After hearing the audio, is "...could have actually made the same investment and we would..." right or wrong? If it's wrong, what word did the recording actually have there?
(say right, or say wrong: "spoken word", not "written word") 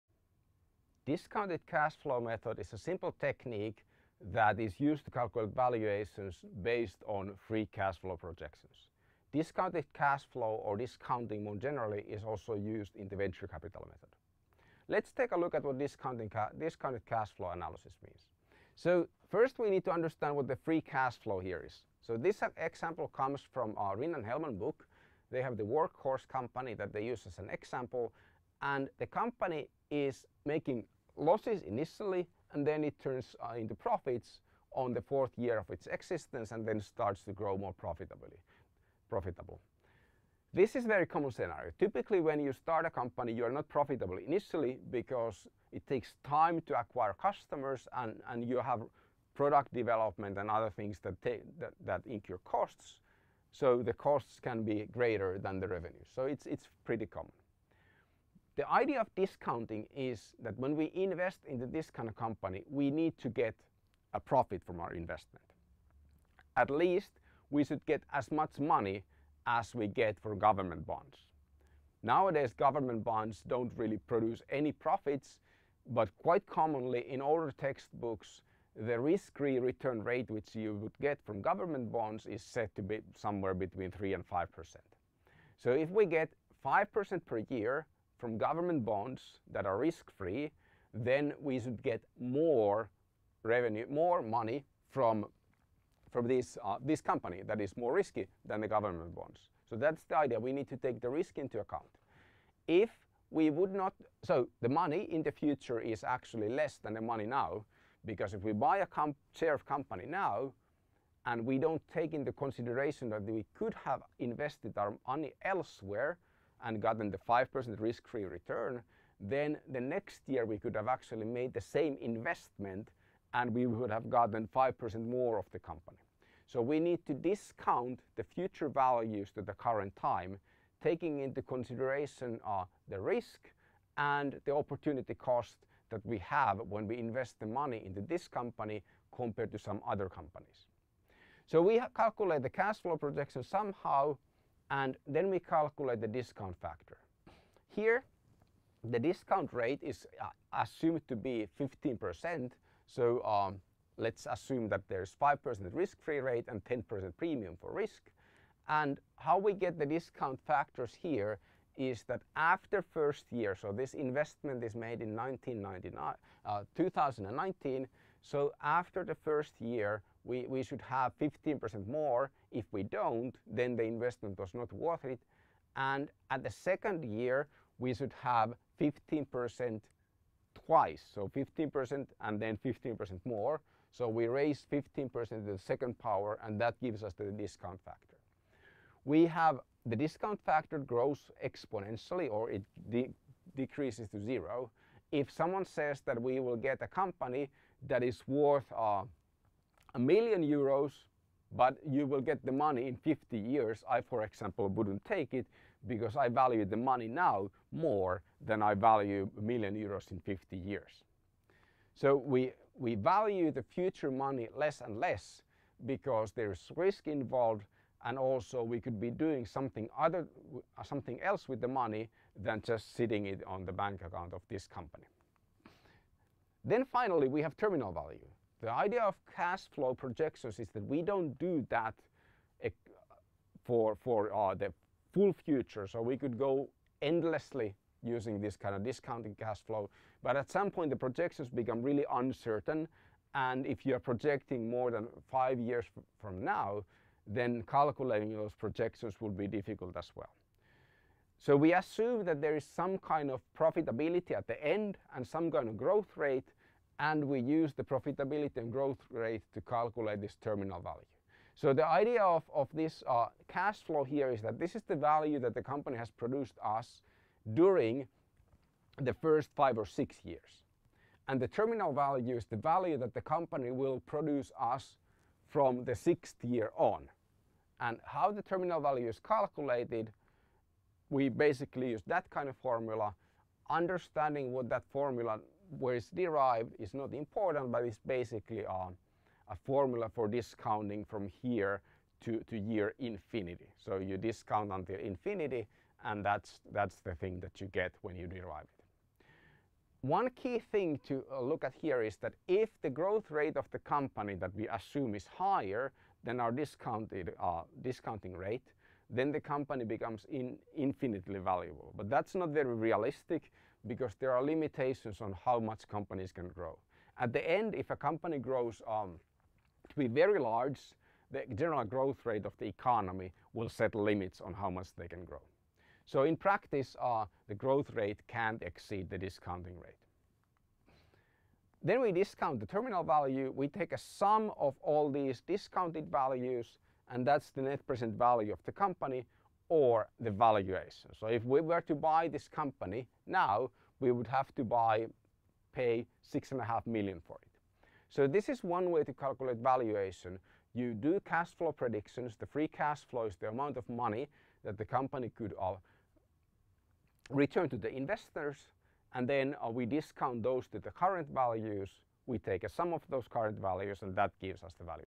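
right.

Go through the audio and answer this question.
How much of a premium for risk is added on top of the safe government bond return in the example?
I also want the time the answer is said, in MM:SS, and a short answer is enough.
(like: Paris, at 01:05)
10%, at 02:36.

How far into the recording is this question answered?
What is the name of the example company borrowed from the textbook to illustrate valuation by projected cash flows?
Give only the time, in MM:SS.
00:25.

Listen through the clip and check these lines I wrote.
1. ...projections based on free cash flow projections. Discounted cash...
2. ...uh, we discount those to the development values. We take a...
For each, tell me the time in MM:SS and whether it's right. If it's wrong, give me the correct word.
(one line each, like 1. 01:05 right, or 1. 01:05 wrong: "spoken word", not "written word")
1. 00:05 wrong: "valuations", not "projections"
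2. 05:59 wrong: "current", not "development".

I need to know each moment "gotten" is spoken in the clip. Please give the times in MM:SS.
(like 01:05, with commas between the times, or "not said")
01:56, 02:04.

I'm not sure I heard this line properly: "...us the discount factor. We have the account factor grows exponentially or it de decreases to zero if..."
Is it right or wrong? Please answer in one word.
wrong.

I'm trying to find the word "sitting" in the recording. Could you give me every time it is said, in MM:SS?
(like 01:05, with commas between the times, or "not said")
03:42.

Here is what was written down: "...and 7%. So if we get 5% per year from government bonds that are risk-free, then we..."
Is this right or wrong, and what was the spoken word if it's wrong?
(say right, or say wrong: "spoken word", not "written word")
wrong: "5", not "7".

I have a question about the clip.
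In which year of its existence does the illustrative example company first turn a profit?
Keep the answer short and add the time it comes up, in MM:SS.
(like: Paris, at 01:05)
4th year, at 00:35.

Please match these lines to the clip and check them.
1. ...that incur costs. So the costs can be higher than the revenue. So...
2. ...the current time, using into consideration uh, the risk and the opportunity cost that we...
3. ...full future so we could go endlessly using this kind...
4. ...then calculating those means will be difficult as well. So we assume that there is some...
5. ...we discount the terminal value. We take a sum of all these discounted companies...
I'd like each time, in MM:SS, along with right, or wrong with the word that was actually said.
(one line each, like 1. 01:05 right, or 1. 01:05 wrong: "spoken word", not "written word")
1. 00:51 wrong: "greater", not "higher"
2. 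02:09 wrong: "taking", not "using"
3. 03:55 right
4. 04:07 wrong: "projections", not "means"
5. 05:32 wrong: "values", not "companies".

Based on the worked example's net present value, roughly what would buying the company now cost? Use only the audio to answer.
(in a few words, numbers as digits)
6.5 million.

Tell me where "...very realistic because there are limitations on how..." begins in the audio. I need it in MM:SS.
05:12.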